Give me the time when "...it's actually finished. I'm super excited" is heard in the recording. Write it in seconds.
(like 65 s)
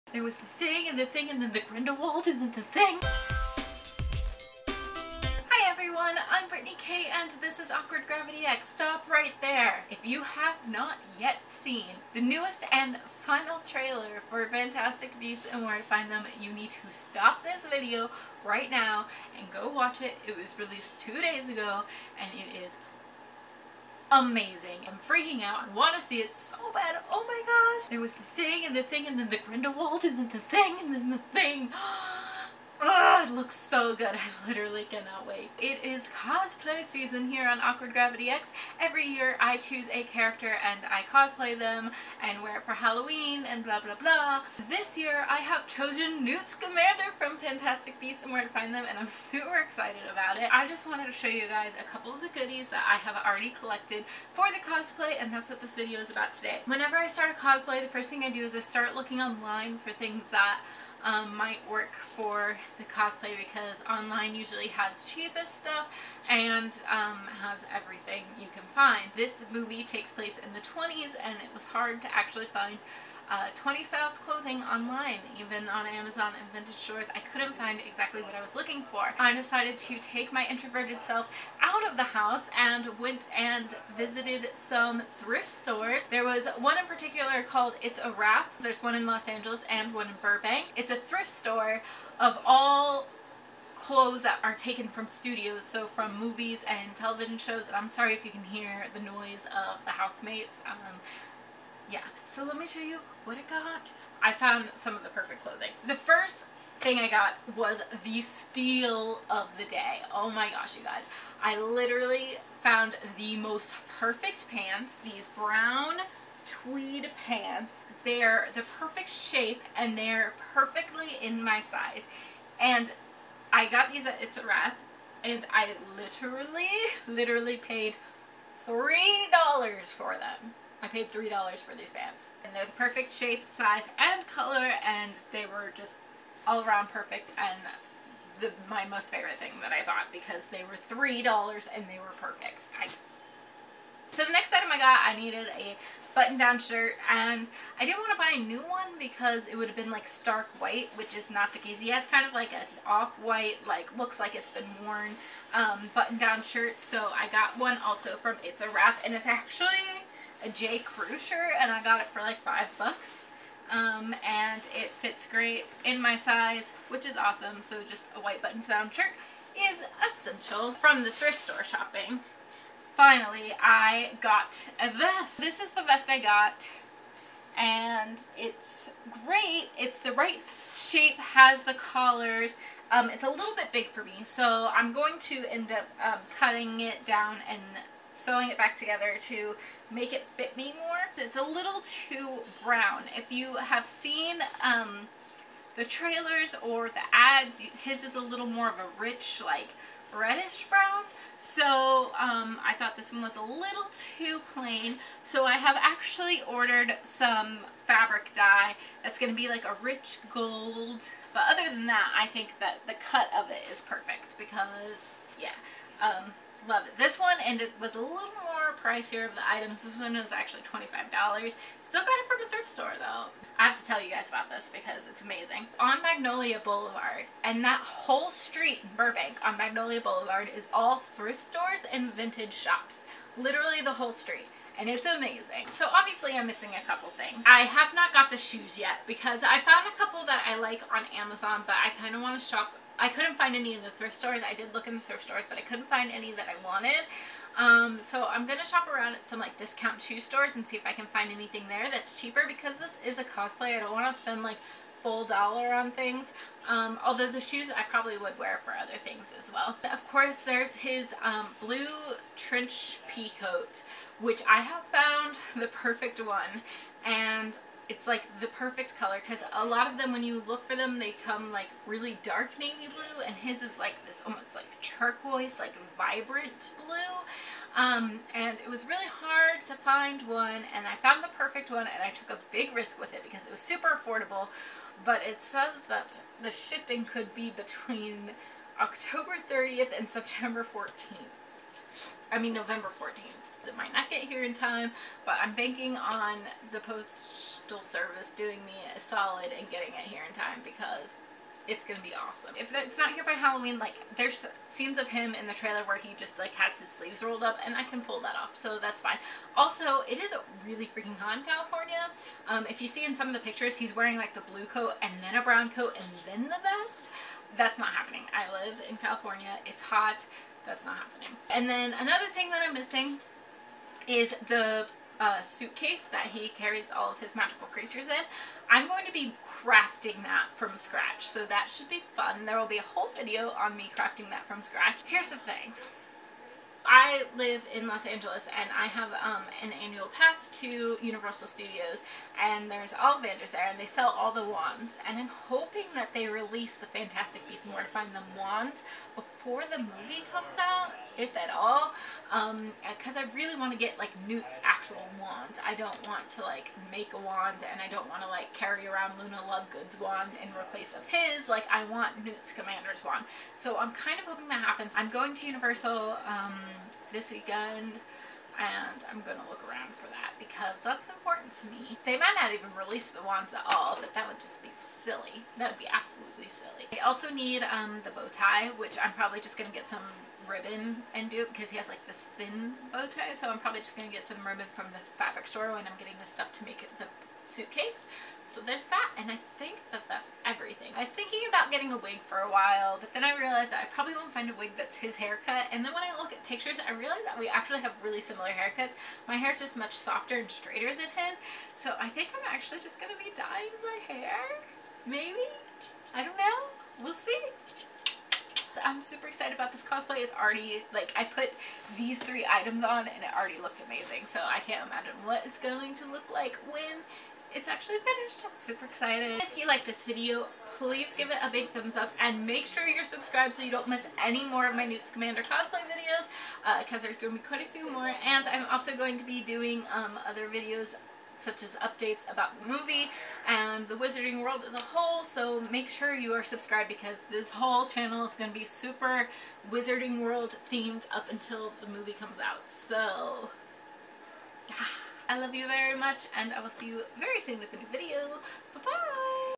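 417 s.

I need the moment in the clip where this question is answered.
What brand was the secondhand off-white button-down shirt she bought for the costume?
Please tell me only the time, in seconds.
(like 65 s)
160 s.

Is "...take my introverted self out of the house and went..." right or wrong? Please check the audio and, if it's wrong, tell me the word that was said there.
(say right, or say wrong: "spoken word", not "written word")
right.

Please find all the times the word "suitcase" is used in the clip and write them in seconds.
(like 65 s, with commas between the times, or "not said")
325 s, 387 s.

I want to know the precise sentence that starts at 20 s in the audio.
It was released two days ago and it is amazing.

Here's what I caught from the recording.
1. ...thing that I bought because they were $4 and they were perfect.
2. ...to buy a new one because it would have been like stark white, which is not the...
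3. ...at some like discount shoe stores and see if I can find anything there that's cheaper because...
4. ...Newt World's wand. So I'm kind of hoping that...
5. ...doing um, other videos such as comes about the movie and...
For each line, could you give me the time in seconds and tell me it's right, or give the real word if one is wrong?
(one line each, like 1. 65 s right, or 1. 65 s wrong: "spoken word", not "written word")
1. 139 s wrong: "3", not "4"
2. 148 s right
3. 249 s right
4. 362 s wrong: "Scamander", not "World"
5. 429 s wrong: "updates", not "comes".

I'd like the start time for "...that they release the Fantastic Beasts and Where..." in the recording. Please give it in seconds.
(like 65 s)
345 s.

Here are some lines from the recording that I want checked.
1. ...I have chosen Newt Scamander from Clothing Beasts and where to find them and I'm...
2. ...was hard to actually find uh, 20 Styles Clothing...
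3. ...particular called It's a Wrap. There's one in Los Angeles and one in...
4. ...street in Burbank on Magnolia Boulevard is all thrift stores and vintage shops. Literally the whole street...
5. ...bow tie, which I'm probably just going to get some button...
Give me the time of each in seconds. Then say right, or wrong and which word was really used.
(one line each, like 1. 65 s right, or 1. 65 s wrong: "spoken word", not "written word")
1. 45 s wrong: "Fantastic", not "Clothing"
2. 71 s right
3. 86 s right
4. 228 s right
5. 378 s wrong: "ribbon", not "button".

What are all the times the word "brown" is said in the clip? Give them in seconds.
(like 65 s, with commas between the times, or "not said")
115 s, 192 s, 200 s, 315 s.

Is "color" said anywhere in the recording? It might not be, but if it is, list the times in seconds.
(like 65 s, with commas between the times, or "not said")
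134 s, 268 s.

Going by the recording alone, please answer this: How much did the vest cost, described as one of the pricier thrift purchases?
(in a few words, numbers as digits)
$25.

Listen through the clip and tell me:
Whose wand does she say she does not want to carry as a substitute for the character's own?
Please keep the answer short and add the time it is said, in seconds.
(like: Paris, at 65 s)
Luna Lovegood, at 359 s.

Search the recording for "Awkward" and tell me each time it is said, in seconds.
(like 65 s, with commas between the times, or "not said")
7 s, 37 s.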